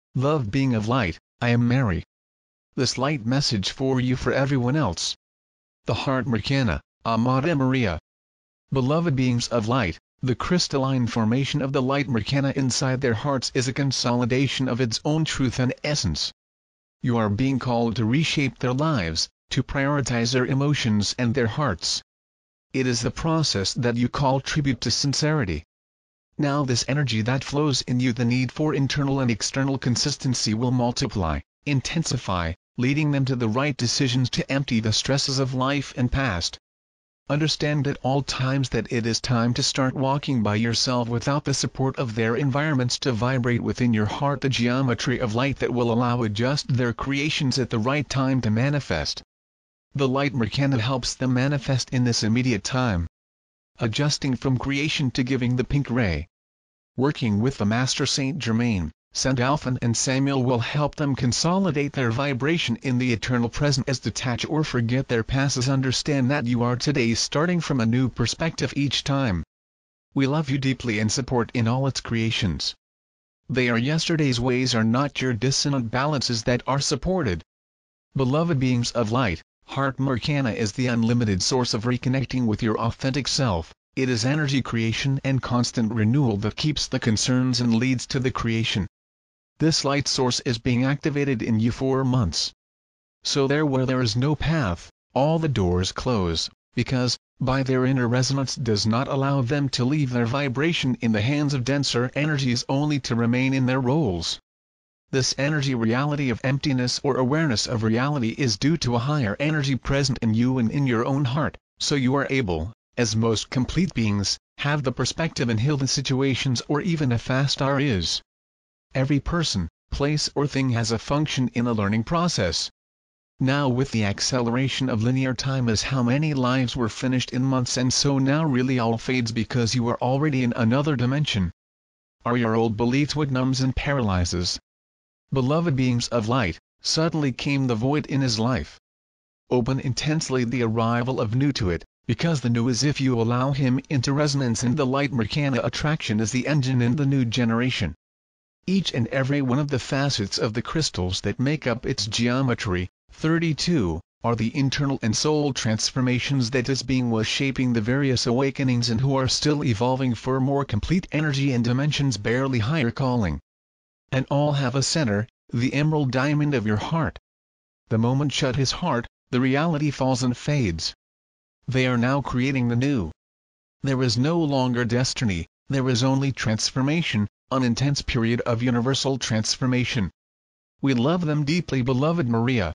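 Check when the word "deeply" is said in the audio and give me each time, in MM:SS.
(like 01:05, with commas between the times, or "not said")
01:10, 03:01.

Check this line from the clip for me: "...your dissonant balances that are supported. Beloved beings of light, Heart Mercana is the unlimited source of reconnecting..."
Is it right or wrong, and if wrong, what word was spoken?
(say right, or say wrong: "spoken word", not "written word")
right.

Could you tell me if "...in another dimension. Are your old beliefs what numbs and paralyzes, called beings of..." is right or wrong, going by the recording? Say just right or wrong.
wrong.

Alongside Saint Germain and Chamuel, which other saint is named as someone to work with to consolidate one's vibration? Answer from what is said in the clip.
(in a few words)
Saint Alphan.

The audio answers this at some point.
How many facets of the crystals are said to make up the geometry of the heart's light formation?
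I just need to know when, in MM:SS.
02:33.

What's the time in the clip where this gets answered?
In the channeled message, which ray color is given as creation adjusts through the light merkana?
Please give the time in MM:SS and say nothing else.
00:55.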